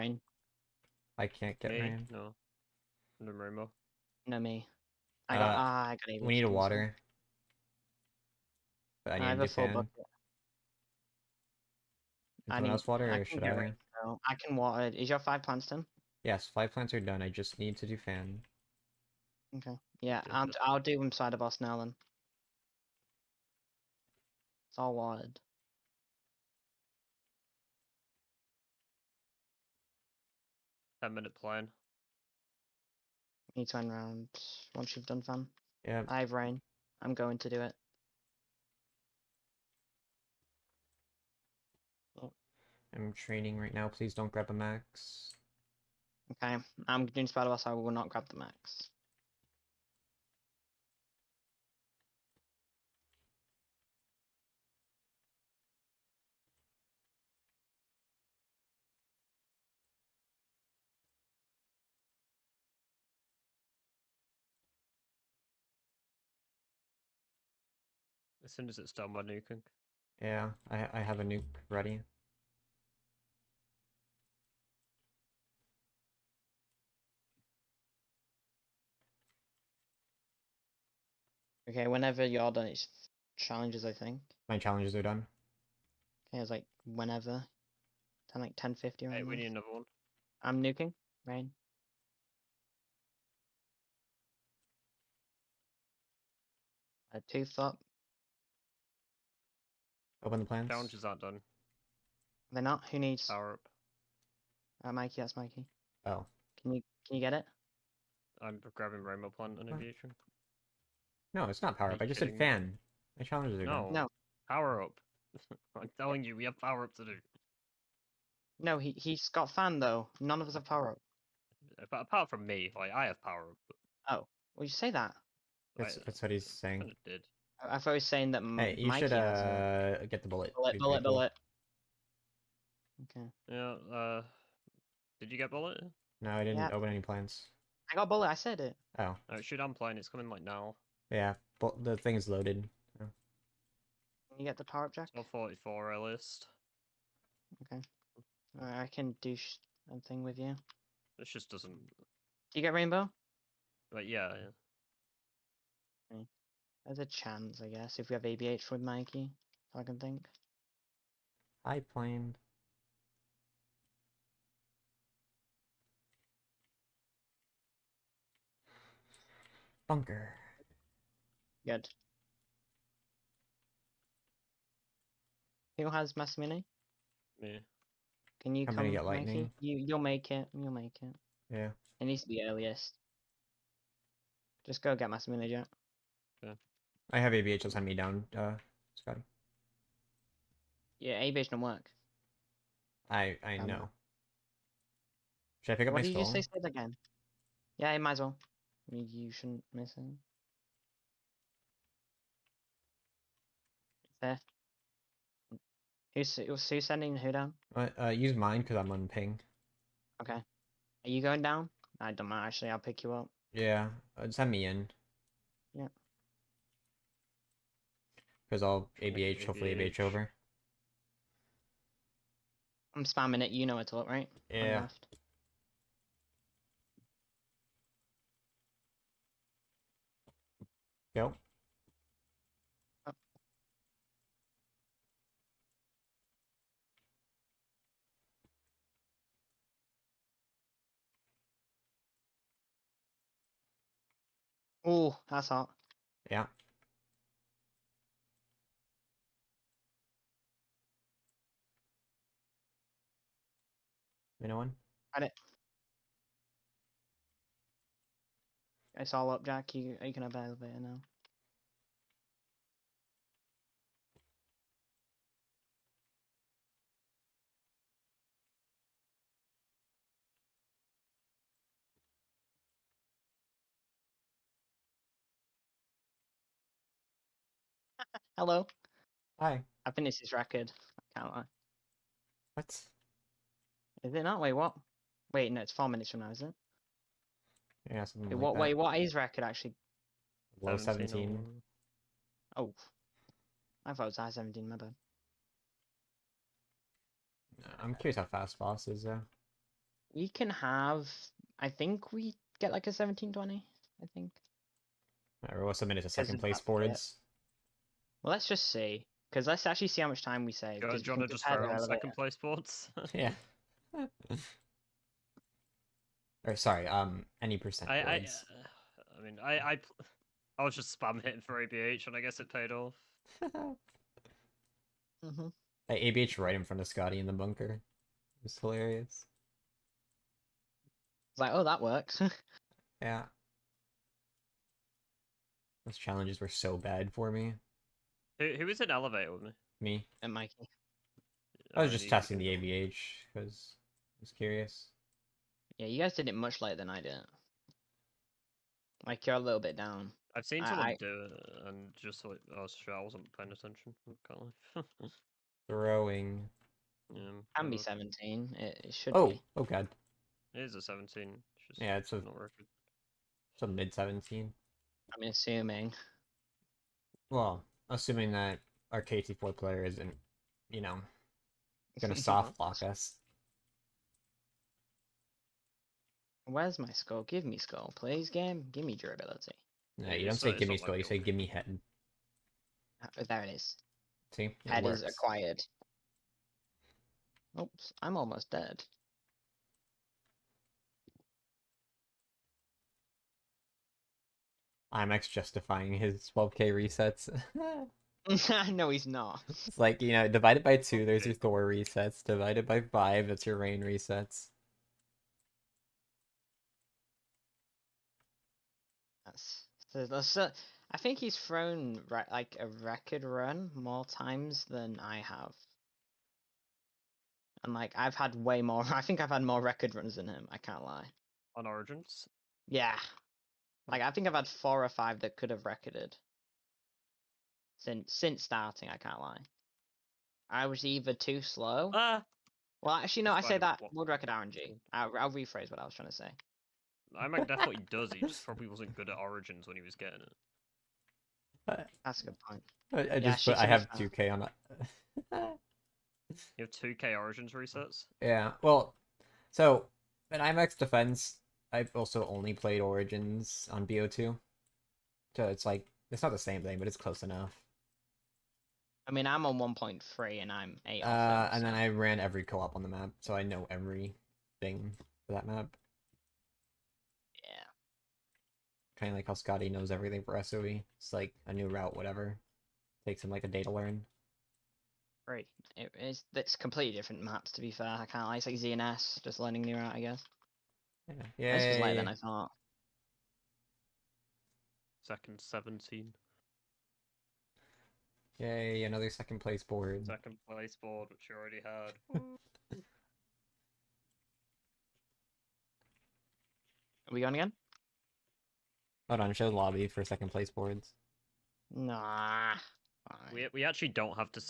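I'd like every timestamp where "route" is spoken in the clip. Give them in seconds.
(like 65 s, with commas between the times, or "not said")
471 s, 479 s.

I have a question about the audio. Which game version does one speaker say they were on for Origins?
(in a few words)
BO2.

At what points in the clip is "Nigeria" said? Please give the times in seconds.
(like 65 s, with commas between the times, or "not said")
not said.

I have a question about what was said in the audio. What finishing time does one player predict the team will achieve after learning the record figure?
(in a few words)
1720.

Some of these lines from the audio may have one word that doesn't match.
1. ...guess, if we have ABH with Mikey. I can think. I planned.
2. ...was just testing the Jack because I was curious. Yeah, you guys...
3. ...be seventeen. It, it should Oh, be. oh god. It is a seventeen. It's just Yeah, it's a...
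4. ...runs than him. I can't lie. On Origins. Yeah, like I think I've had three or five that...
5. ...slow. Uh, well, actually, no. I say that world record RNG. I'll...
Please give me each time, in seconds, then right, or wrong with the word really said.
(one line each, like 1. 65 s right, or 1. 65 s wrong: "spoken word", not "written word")
1. 157 s right
2. 341 s wrong: "ABH", not "Jack"
3. 357 s right
4. 419 s wrong: "four", not "three"
5. 431 s right.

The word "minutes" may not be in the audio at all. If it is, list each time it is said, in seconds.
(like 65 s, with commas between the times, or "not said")
31 s, 285 s, 305 s.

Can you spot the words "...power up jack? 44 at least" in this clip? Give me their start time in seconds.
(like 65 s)
144 s.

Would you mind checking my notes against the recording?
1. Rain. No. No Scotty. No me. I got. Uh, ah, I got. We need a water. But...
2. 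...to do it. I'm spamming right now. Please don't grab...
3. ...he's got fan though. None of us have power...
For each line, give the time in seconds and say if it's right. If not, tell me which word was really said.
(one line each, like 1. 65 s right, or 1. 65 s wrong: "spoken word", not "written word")
1. 1 s wrong: "Rainbow", not "Scotty"
2. 37 s wrong: "training", not "spamming"
3. 118 s right.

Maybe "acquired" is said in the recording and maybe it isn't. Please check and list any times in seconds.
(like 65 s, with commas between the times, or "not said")
385 s.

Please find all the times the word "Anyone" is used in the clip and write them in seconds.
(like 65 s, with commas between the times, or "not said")
254 s.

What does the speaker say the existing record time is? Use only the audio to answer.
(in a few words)
Low 17.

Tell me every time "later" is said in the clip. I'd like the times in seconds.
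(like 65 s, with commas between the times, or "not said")
346 s, 481 s.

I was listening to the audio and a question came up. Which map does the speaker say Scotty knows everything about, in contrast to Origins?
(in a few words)
SOE.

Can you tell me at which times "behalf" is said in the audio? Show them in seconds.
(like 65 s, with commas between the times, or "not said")
not said.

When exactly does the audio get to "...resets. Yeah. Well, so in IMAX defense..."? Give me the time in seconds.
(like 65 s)
447 s.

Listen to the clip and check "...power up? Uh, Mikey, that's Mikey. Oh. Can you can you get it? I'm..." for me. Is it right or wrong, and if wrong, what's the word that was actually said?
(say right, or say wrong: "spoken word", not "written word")
right.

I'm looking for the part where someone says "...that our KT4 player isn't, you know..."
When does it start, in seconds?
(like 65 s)
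368 s.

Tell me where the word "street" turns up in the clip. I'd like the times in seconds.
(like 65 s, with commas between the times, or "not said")
not said.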